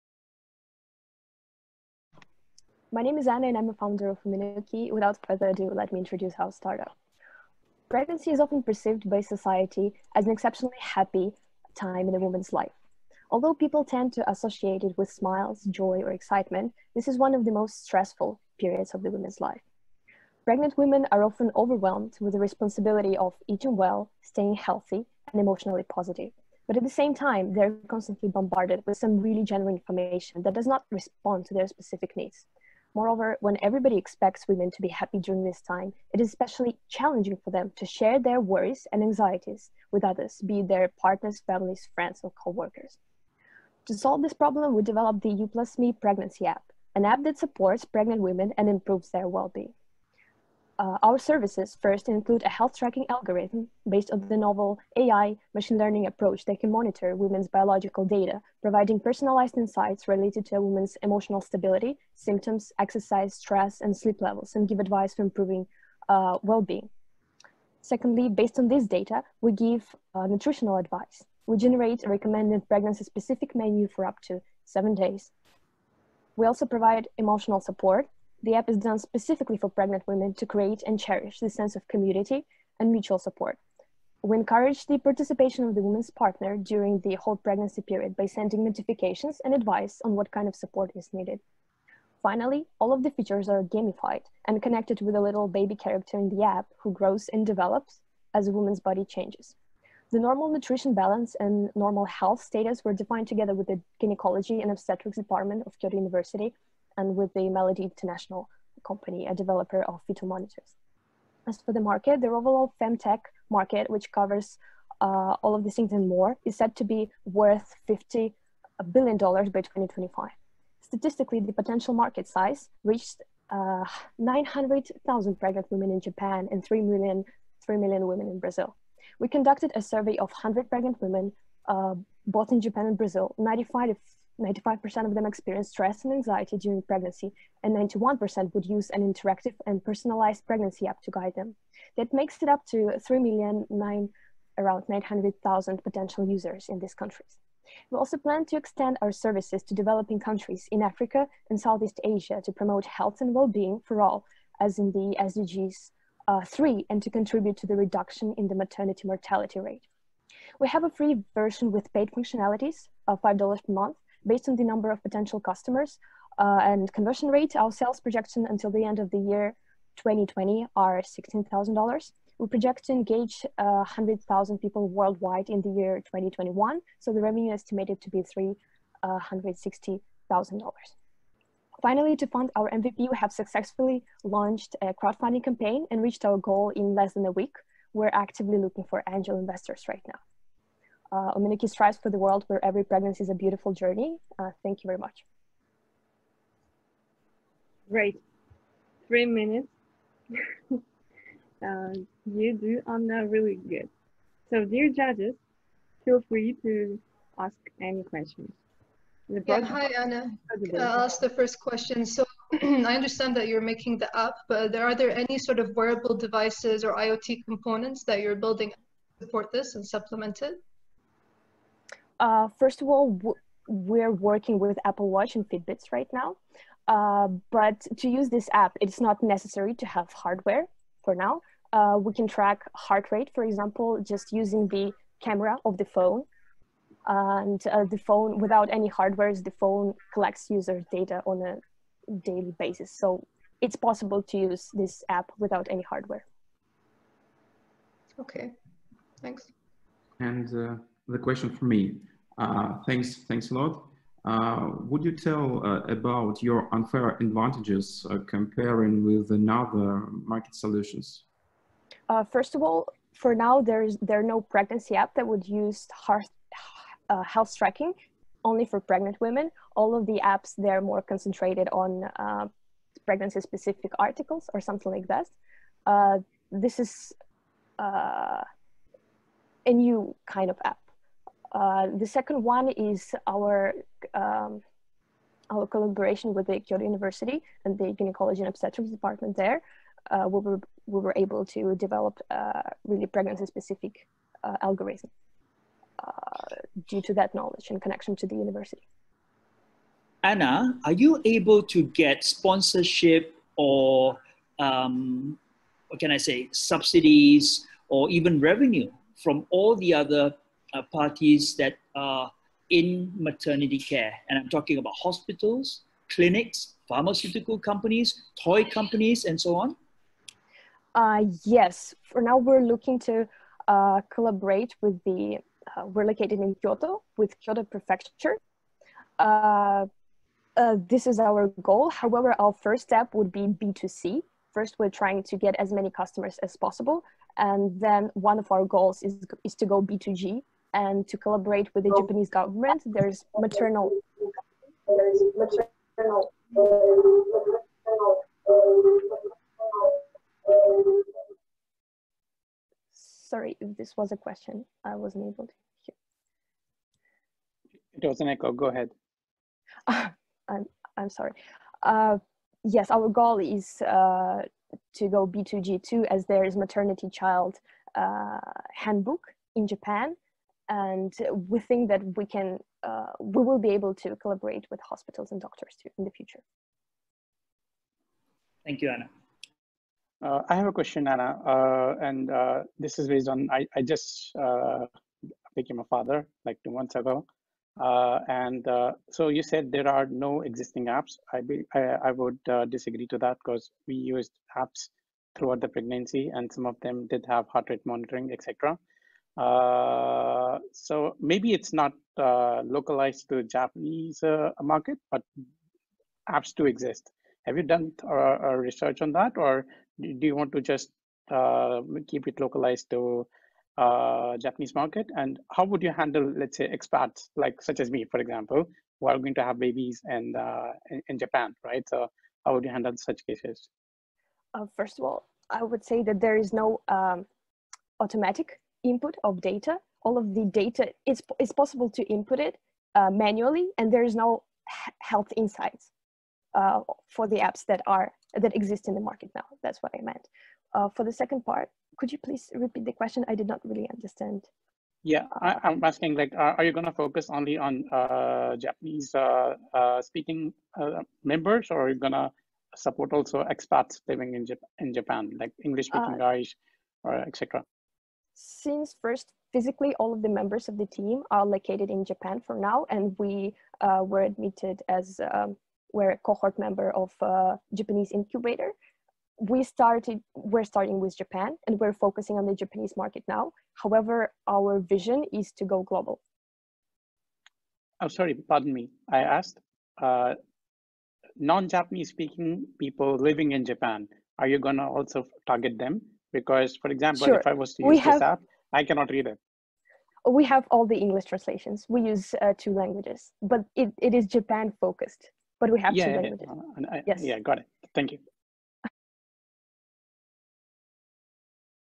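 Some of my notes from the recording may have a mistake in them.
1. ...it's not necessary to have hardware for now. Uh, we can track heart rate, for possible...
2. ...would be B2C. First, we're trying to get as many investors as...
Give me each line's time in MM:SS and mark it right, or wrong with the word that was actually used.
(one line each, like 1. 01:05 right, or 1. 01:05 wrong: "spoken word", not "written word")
1. 03:48 wrong: "example", not "possible"
2. 05:33 wrong: "customers", not "investors".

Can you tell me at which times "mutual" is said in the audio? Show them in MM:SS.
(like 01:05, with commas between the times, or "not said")
01:22.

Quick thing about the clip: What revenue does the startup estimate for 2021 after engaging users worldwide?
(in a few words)
$360,000.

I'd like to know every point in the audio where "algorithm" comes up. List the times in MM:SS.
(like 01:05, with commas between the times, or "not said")
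00:53, 04:54.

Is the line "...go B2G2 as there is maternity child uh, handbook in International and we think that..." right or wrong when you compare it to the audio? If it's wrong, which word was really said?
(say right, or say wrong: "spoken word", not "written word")
wrong: "Japan", not "International".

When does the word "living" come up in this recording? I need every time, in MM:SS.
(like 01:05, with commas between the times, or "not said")
07:34, 08:03.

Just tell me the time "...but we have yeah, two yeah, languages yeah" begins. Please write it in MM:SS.
08:15.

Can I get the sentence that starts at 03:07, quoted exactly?
We're actively looking for angel investors right now uh, Ominiki strives for the world where every pregnancy is a beautiful journey.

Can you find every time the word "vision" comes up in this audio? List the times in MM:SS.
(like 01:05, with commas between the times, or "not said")
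07:54.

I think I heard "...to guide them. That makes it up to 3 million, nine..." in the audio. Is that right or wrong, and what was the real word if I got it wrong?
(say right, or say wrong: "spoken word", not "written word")
right.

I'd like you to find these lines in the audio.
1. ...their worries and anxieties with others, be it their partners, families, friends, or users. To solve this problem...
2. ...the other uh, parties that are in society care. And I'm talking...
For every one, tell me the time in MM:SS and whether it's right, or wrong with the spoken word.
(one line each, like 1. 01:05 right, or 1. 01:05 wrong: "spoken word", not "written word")
1. 00:38 wrong: "coworkers", not "users"
2. 05:09 wrong: "maternity", not "society".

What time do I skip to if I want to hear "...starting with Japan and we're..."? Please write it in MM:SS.
07:50.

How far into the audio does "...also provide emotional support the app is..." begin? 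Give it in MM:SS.
01:16.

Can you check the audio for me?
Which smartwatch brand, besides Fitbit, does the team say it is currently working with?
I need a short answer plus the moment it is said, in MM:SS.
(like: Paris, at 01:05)
Apple Watch, at 03:44.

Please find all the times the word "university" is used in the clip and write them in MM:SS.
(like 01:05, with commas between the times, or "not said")
01:45, 04:46, 04:58.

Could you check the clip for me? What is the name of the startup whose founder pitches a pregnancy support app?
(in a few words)
Umenoki.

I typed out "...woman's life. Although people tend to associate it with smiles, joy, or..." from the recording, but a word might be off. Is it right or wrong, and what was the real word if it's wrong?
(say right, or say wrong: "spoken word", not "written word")
right.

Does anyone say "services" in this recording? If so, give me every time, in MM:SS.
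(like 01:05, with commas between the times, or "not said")
00:51, 02:29.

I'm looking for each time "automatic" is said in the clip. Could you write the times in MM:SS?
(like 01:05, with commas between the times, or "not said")
07:08.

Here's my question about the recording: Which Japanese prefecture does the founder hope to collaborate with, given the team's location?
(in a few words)
Kyoto Prefecture.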